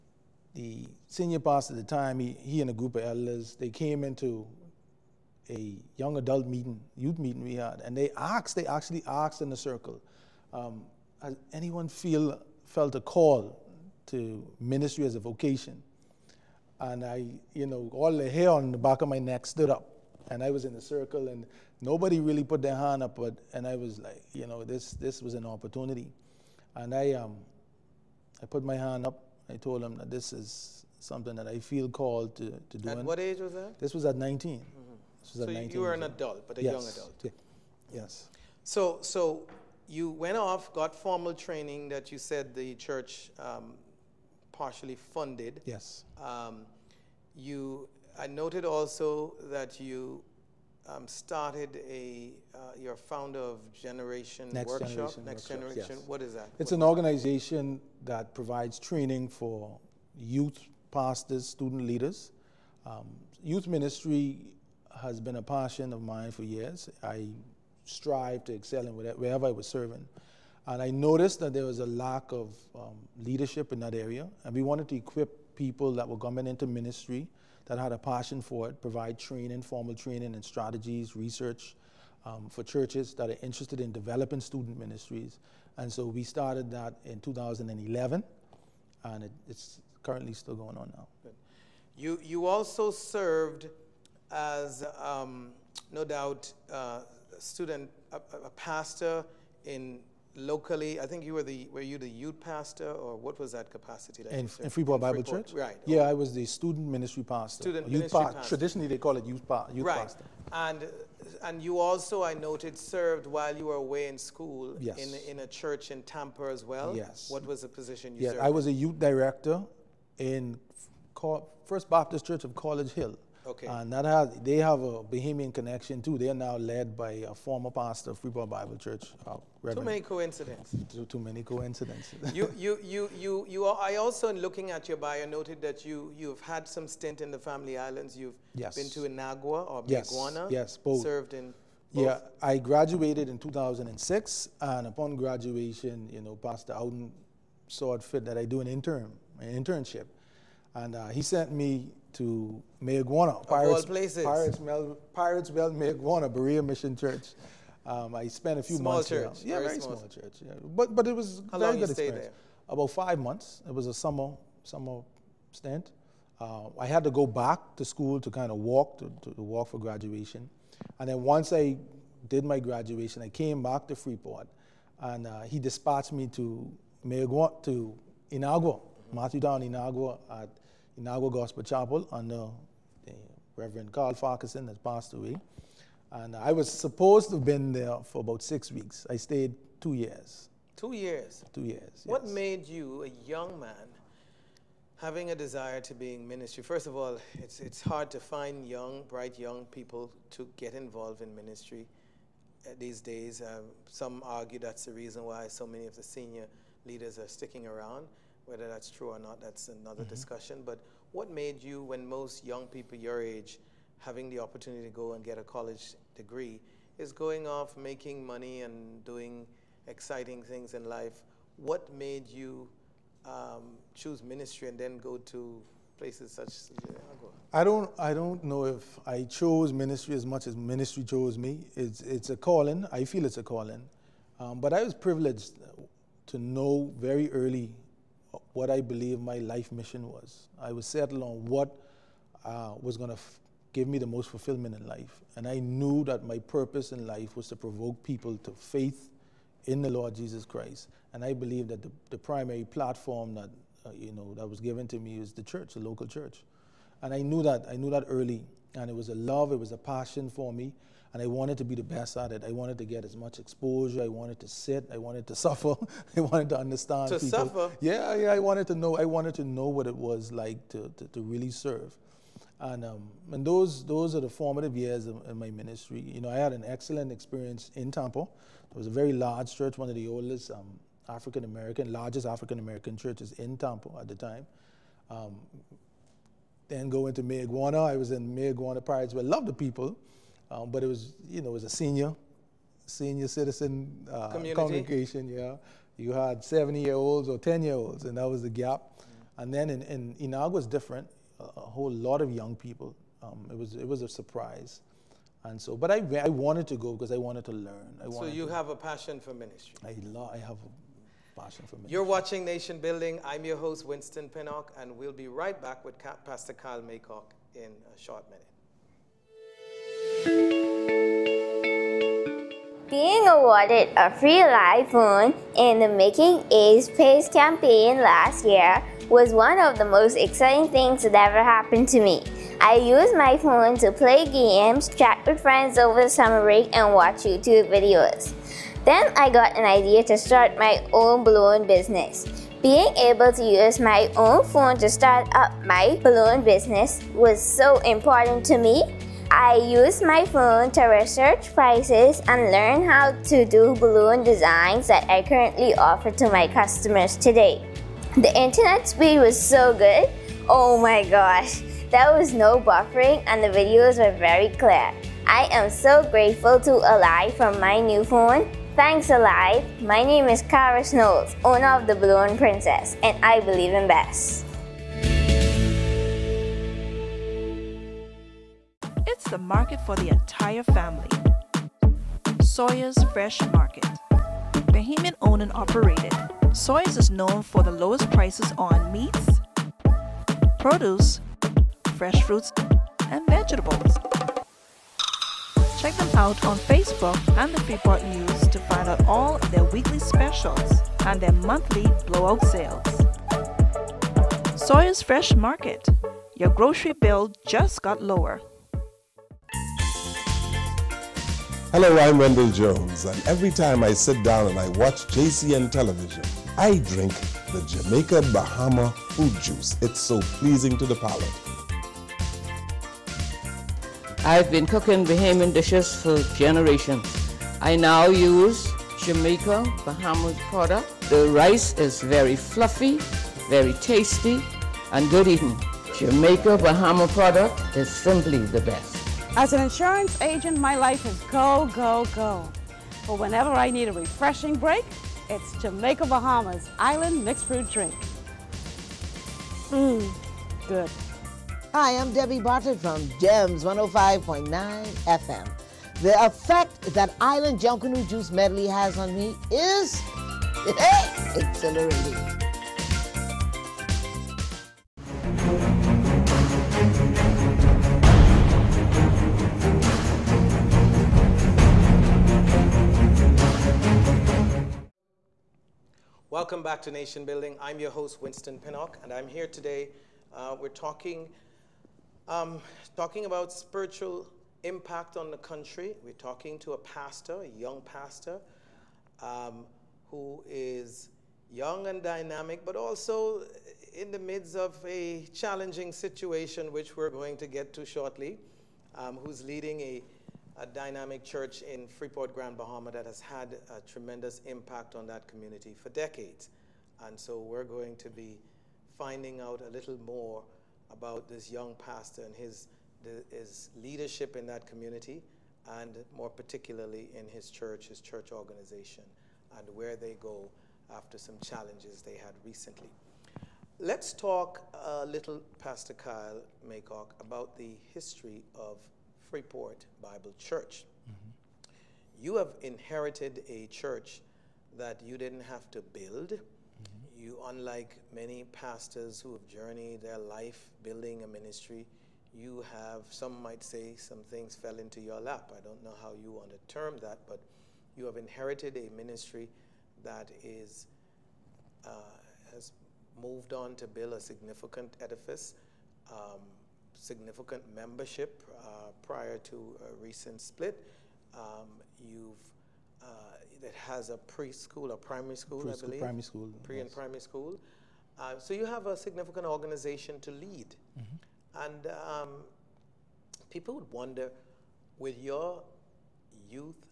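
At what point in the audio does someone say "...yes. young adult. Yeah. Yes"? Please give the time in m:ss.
0:36.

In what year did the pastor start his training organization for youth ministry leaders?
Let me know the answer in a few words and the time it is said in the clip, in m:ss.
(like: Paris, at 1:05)
2011, at 1:27.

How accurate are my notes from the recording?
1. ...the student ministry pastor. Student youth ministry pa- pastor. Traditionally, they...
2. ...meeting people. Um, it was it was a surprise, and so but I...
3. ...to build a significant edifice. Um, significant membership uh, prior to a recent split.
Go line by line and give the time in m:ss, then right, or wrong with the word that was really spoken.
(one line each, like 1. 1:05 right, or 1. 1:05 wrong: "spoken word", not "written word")
1. 1:46 right
2. 5:02 wrong: "young", not "meeting"
3. 9:13 right.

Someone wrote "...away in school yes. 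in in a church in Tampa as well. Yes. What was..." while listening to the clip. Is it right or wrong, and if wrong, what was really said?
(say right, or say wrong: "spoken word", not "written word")
right.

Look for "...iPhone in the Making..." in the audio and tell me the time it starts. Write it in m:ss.
5:24.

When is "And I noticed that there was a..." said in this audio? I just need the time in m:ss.
1:10.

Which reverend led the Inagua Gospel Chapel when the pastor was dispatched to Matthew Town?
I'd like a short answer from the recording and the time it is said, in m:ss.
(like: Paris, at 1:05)
Carl Farquharson, at 3:03.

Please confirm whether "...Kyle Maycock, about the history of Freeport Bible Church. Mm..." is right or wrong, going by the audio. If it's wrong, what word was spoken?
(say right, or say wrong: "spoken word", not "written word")
right.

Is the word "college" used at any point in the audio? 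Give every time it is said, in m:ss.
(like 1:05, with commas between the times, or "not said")
2:02, 3:35.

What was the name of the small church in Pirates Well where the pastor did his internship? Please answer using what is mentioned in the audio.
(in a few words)
Berea Mission Church.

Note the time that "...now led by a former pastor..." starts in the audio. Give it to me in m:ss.
2:06.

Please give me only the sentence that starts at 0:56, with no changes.
It's what an organization that provides training for youth pastors, student leaders.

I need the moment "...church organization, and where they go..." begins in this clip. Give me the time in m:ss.
8:38.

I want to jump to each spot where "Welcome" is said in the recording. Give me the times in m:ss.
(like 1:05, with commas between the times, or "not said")
7:56.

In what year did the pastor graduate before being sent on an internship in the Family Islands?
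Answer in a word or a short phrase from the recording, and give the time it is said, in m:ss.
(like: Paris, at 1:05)
2006, at 2:23.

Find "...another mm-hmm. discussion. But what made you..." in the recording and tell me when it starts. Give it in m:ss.
3:29.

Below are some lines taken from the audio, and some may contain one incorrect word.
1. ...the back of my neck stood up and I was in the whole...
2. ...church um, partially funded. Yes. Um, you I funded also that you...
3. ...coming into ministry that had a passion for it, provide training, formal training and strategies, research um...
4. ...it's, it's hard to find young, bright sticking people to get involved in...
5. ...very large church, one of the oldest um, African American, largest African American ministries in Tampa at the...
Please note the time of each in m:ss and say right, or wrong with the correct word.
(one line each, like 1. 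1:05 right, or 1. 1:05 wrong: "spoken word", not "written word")
1. 0:18 wrong: "circle", not "whole"
2. 0:42 wrong: "noted", not "funded"
3. 1:16 right
4. 3:17 wrong: "young", not "sticking"
5. 4:38 wrong: "churches", not "ministries".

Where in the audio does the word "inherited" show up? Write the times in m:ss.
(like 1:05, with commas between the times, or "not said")
8:52, 9:08.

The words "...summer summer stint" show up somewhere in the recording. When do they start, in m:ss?
2:43.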